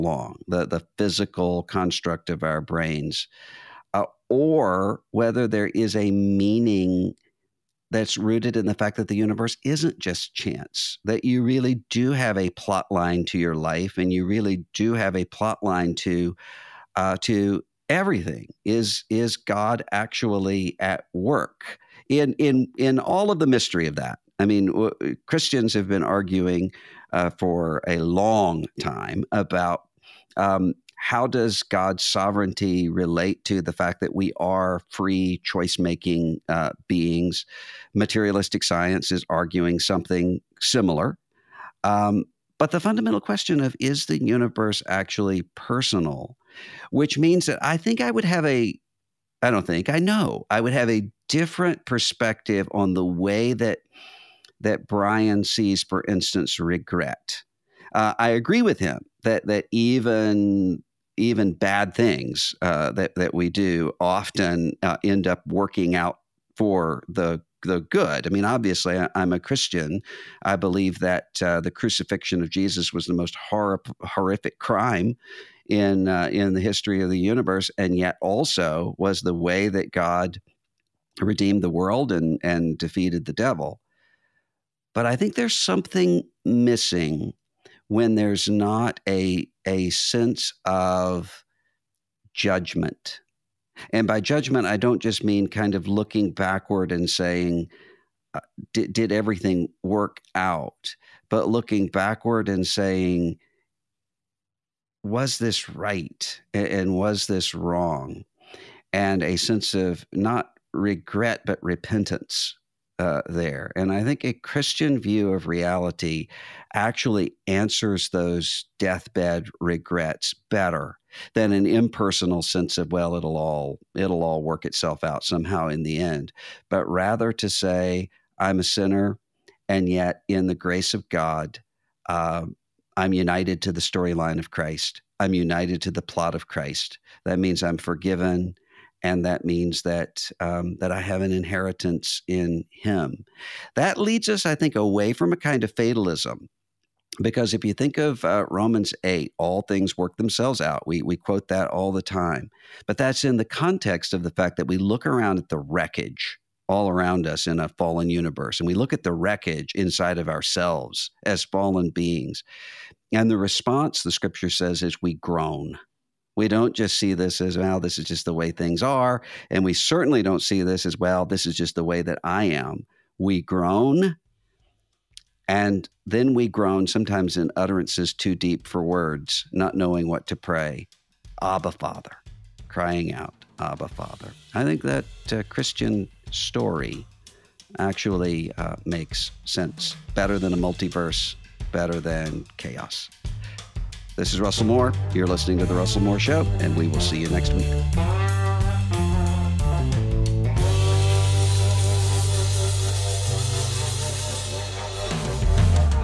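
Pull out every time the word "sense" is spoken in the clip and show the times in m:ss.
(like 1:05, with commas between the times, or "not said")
1:29, 1:49, 2:02, 3:09.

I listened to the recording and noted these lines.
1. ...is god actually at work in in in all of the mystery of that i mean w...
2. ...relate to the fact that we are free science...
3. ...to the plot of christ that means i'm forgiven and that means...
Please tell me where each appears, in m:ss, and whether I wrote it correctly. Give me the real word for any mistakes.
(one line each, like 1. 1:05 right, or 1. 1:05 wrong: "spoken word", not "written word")
1. 0:19 right
2. 0:32 wrong: "choice", not "science"
3. 2:15 right.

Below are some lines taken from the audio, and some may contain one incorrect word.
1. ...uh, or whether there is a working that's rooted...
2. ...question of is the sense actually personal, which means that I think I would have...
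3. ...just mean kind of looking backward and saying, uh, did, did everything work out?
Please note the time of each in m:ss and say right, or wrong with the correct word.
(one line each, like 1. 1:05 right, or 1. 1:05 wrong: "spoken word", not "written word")
1. 0:03 wrong: "meaning", not "working"
2. 0:43 wrong: "universe", not "sense"
3. 1:35 right.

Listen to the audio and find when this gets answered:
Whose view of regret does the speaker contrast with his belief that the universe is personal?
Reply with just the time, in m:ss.
0:54.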